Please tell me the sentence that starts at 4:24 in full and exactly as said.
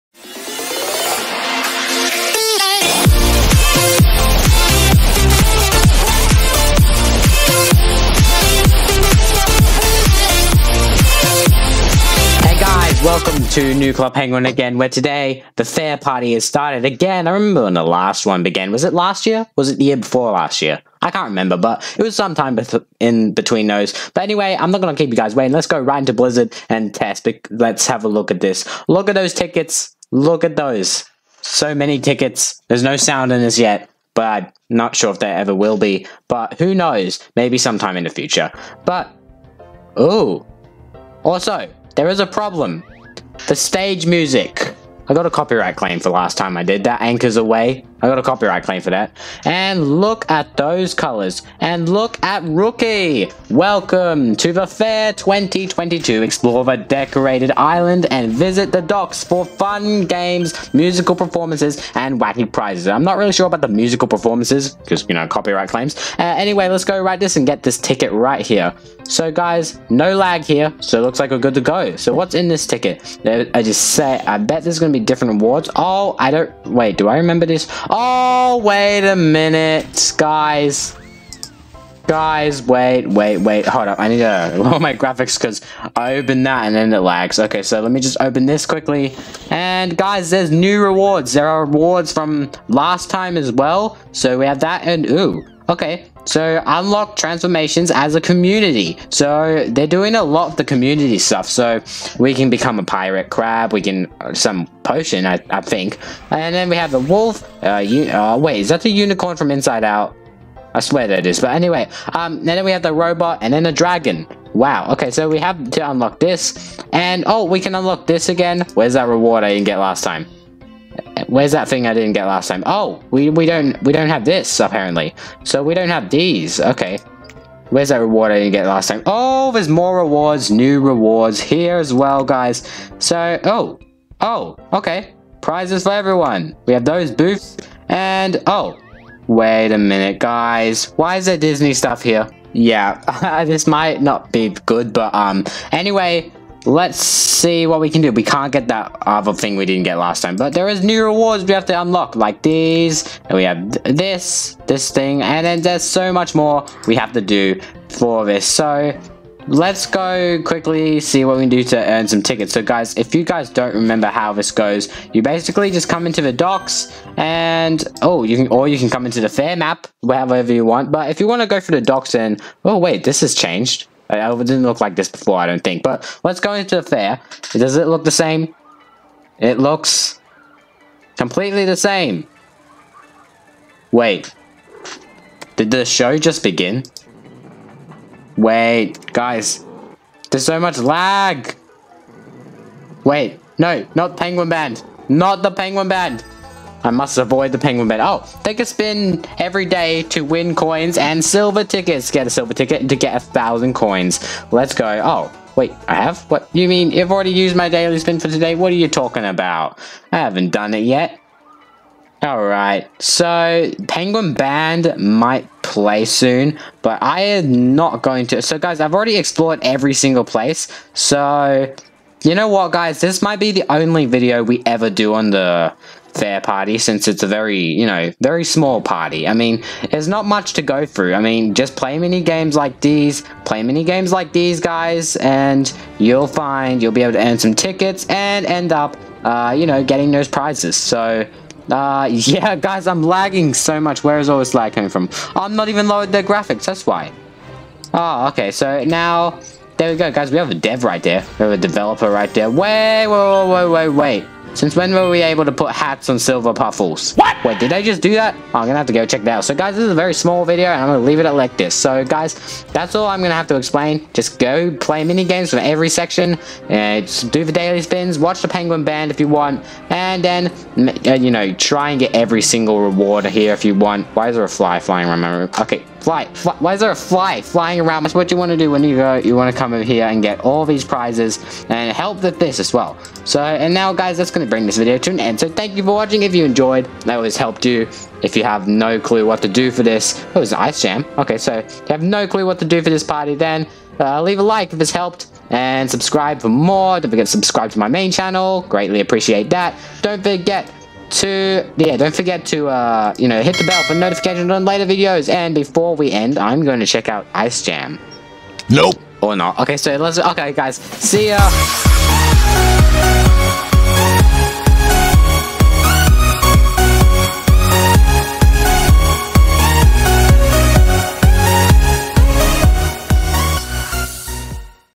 Just go play mini games from every section.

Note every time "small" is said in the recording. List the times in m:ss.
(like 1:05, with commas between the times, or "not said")
3:48, 4:20.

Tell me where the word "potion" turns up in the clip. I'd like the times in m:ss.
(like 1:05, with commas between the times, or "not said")
1:44.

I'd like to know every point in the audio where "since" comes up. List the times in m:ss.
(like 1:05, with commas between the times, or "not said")
3:46, 4:14.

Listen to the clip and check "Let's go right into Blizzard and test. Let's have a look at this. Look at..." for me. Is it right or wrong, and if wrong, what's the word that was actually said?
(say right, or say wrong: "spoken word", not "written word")
right.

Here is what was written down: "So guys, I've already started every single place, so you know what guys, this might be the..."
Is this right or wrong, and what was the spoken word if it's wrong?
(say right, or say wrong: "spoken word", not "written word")
wrong: "explored", not "started".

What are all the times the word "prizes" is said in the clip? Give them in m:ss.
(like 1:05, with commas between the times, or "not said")
1:02, 2:15, 4:00, 4:40.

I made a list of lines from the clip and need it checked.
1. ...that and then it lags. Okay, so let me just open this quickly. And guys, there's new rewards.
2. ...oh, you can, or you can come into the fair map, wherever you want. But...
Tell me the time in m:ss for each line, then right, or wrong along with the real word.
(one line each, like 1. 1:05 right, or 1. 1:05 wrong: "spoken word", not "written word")
1. 1:26 right
2. 2:48 right.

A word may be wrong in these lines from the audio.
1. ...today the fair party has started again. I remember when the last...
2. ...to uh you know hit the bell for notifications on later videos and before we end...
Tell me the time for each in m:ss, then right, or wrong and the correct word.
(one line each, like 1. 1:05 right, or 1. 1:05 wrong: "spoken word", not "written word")
1. 0:14 right
2. 5:02 right.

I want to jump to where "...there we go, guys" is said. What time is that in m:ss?
4:09.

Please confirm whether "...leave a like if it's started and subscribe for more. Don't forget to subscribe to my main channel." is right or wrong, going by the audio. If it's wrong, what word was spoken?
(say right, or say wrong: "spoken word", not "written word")
wrong: "helped", not "started".